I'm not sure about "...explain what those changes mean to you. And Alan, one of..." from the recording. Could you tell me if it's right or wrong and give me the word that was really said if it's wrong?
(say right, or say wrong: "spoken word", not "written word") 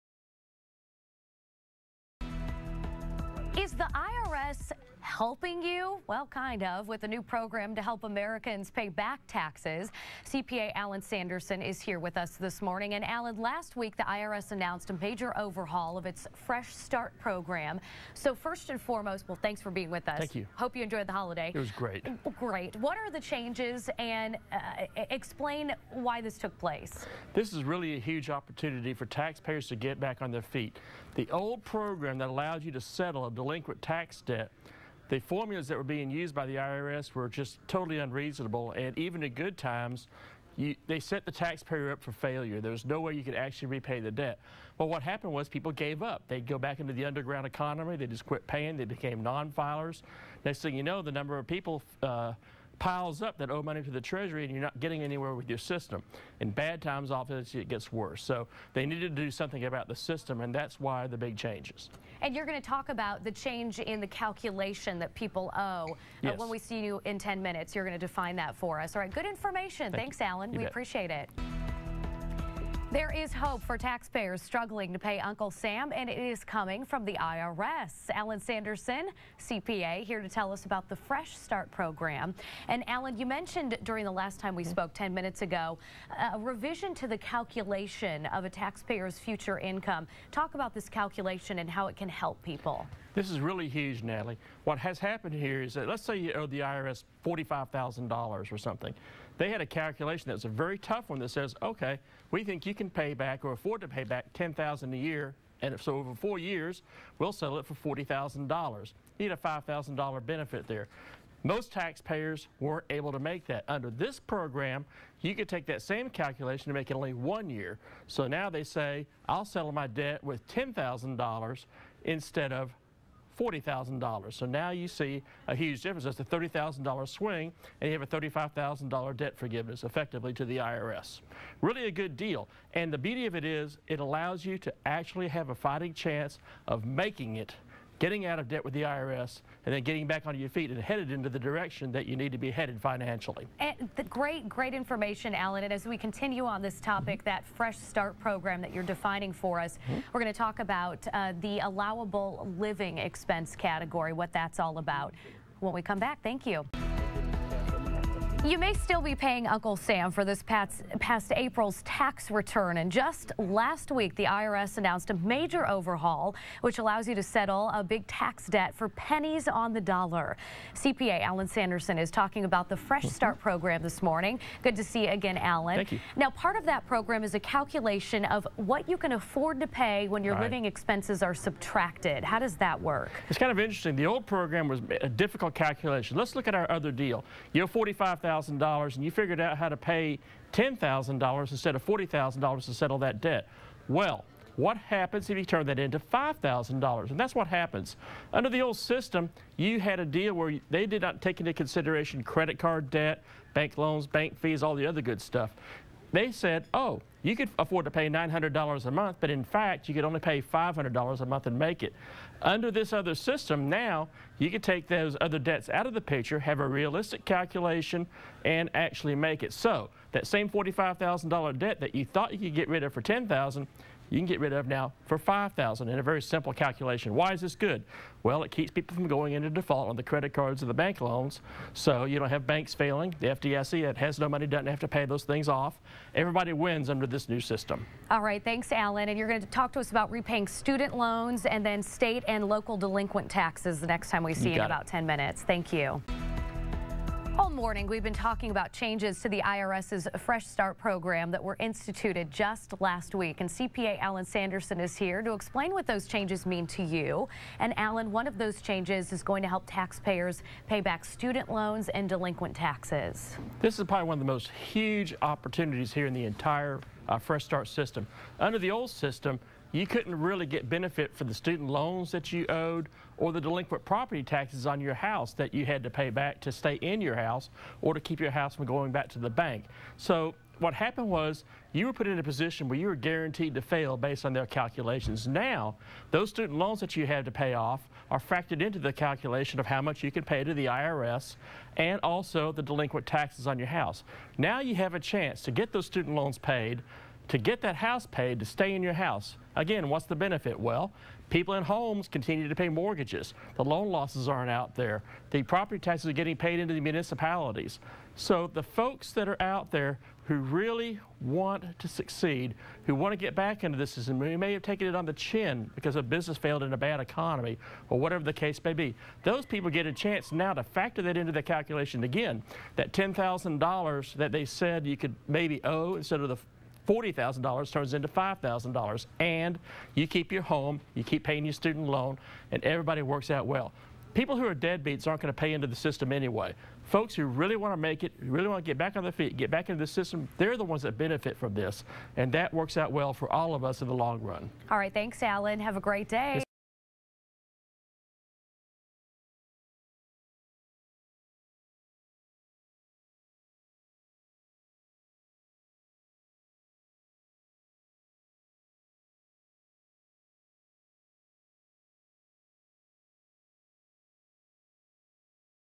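right.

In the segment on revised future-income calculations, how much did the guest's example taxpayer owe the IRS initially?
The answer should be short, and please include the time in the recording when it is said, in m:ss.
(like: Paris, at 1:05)
$45,000, at 1:37.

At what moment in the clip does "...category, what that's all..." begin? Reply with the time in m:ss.
2:33.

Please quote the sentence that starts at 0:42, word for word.
There was no way you could actually repay the debt.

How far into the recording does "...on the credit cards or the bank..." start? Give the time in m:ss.
3:49.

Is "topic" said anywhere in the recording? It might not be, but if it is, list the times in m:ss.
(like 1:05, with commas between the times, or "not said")
2:26.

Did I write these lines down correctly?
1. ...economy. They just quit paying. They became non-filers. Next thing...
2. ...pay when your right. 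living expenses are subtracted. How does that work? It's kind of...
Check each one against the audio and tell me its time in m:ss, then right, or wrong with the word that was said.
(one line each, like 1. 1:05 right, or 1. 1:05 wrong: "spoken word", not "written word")
1. 0:47 right
2. 2:59 right.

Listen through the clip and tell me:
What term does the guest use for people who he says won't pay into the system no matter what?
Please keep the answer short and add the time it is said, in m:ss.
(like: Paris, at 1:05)
deadbeats, at 5:34.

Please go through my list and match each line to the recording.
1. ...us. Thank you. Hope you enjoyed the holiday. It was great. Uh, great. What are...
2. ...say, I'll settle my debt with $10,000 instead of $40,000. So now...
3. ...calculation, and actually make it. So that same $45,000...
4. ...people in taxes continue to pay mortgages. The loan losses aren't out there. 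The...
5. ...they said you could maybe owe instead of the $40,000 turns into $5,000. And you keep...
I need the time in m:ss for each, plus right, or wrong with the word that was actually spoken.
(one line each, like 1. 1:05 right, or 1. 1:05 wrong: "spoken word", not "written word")
1. 0:20 right
2. 1:58 right
3. 3:37 right
4. 5:01 wrong: "homes", not "taxes"
5. 5:24 right.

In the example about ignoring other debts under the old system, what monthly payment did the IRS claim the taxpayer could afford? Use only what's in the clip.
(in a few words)
$900 a month.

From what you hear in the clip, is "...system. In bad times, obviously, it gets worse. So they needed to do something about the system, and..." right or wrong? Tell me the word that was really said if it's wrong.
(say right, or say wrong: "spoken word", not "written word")
right.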